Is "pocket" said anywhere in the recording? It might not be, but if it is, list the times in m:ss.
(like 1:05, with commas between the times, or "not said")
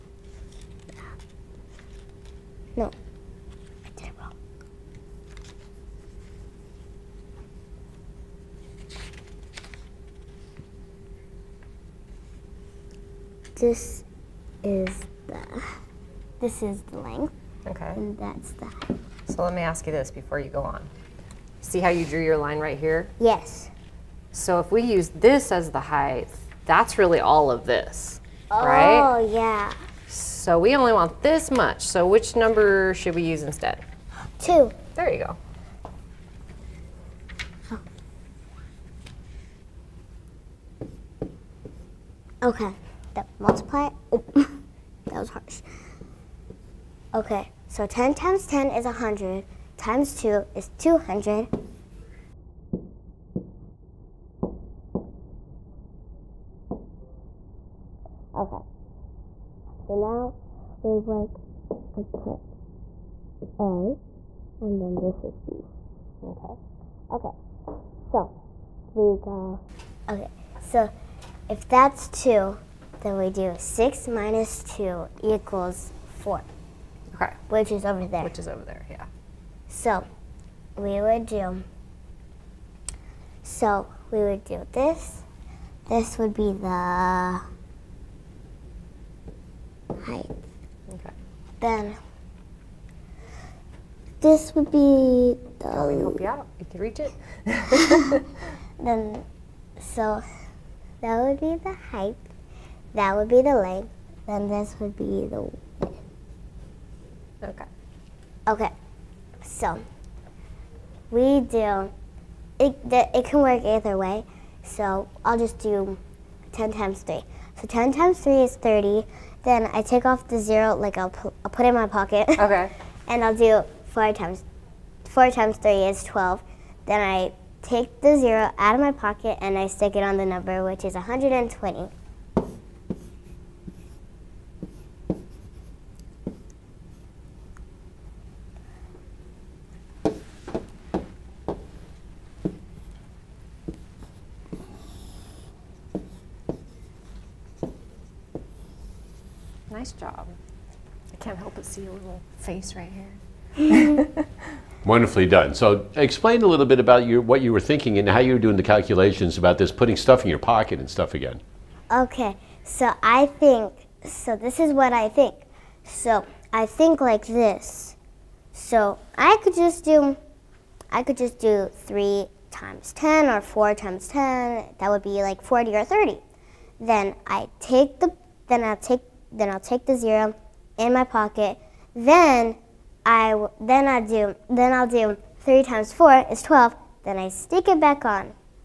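2:01, 2:08, 2:40, 3:01.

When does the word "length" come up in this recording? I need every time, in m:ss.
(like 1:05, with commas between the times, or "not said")
0:16, 1:43.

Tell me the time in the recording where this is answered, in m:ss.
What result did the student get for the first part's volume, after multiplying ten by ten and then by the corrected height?
0:50.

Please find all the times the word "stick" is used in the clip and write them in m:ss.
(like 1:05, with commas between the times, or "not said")
2:09, 3:07.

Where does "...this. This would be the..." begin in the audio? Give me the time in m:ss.
1:24.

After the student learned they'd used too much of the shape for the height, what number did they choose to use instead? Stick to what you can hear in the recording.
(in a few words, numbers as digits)
2.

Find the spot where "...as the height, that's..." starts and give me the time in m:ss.
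0:25.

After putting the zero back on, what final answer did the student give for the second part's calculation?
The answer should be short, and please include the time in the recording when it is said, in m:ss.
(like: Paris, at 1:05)
120, at 2:10.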